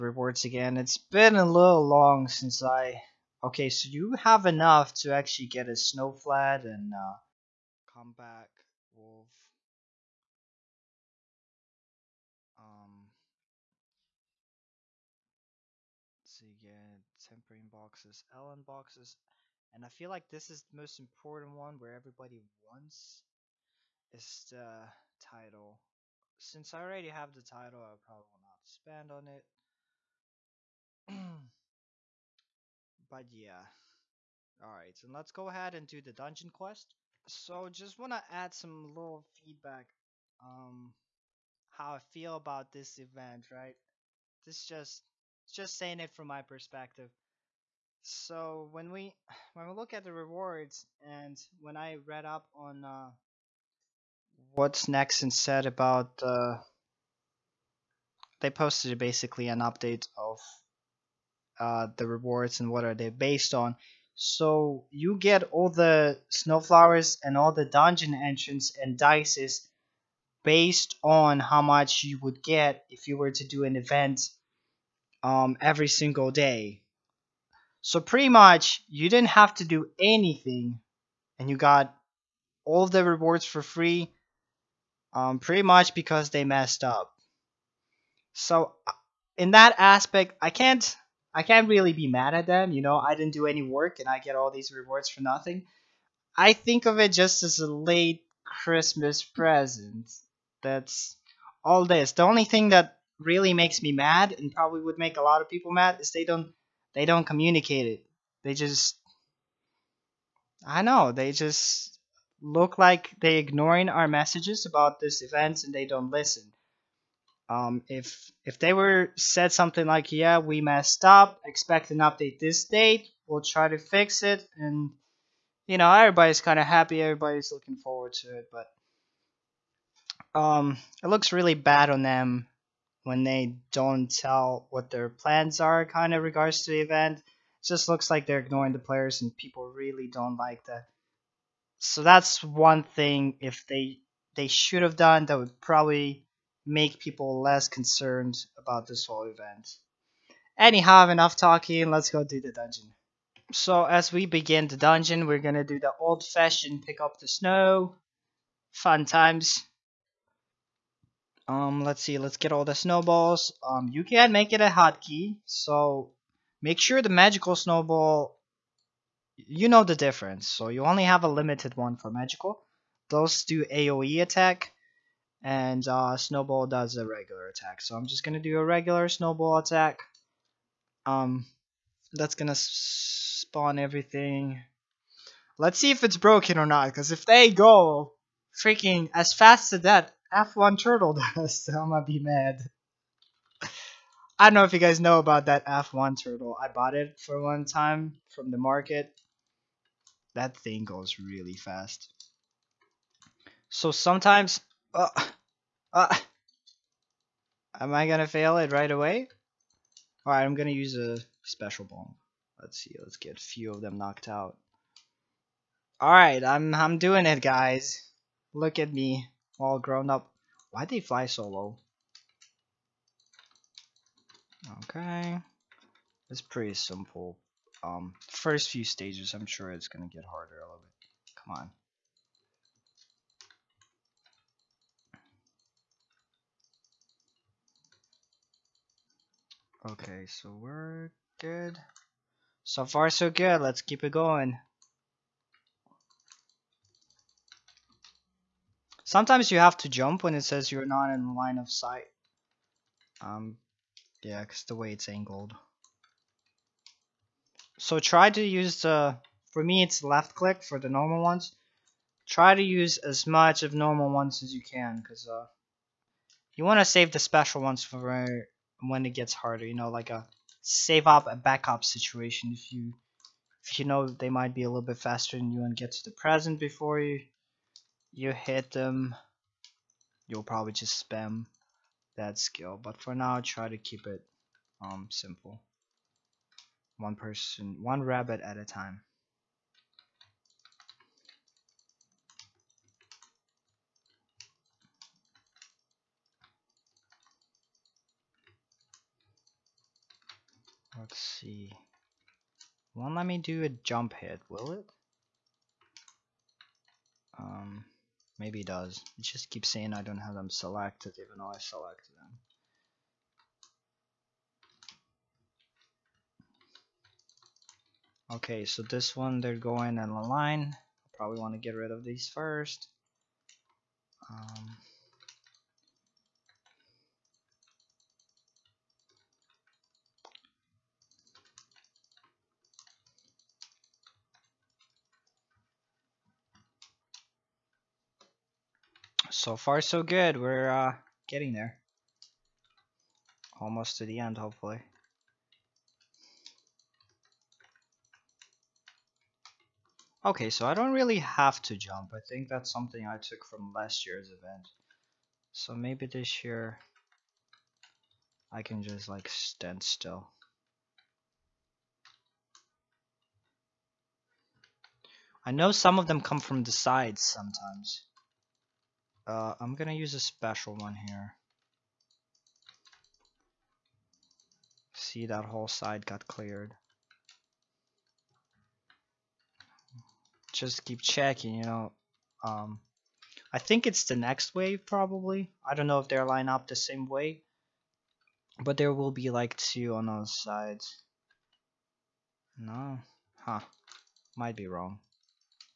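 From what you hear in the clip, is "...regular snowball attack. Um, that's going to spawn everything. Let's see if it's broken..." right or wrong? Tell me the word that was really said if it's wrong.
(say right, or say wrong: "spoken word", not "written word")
right.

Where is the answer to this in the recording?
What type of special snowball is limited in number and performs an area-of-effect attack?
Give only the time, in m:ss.
2:47.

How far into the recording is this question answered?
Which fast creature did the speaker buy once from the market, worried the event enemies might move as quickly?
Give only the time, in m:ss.
3:15.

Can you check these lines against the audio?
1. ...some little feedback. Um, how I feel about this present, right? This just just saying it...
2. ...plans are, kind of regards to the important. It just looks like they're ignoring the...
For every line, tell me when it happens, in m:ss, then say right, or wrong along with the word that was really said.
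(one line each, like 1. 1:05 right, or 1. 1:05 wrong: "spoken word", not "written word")
1. 0:38 wrong: "event", not "present"
2. 2:15 wrong: "event", not "important".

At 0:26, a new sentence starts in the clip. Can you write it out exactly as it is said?
Since I already have the title, I probably will not spend on it.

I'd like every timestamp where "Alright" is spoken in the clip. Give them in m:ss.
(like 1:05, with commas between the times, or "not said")
0:34, 3:30, 3:36.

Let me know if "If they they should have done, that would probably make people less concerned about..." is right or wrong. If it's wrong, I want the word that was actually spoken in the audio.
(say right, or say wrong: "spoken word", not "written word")
right.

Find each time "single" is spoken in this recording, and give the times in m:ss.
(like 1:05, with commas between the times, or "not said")
1:15.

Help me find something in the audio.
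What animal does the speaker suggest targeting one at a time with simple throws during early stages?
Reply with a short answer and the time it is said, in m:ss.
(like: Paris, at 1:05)
Rabbit, at 4:48.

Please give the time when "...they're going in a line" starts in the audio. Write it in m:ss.
5:19.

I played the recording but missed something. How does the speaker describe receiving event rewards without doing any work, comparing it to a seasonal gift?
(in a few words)
A late Christmas present.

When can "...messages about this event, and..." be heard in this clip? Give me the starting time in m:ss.
1:54.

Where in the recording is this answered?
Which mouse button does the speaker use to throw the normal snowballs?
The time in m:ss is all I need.
4:20.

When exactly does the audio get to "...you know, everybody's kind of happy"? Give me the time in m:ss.
2:05.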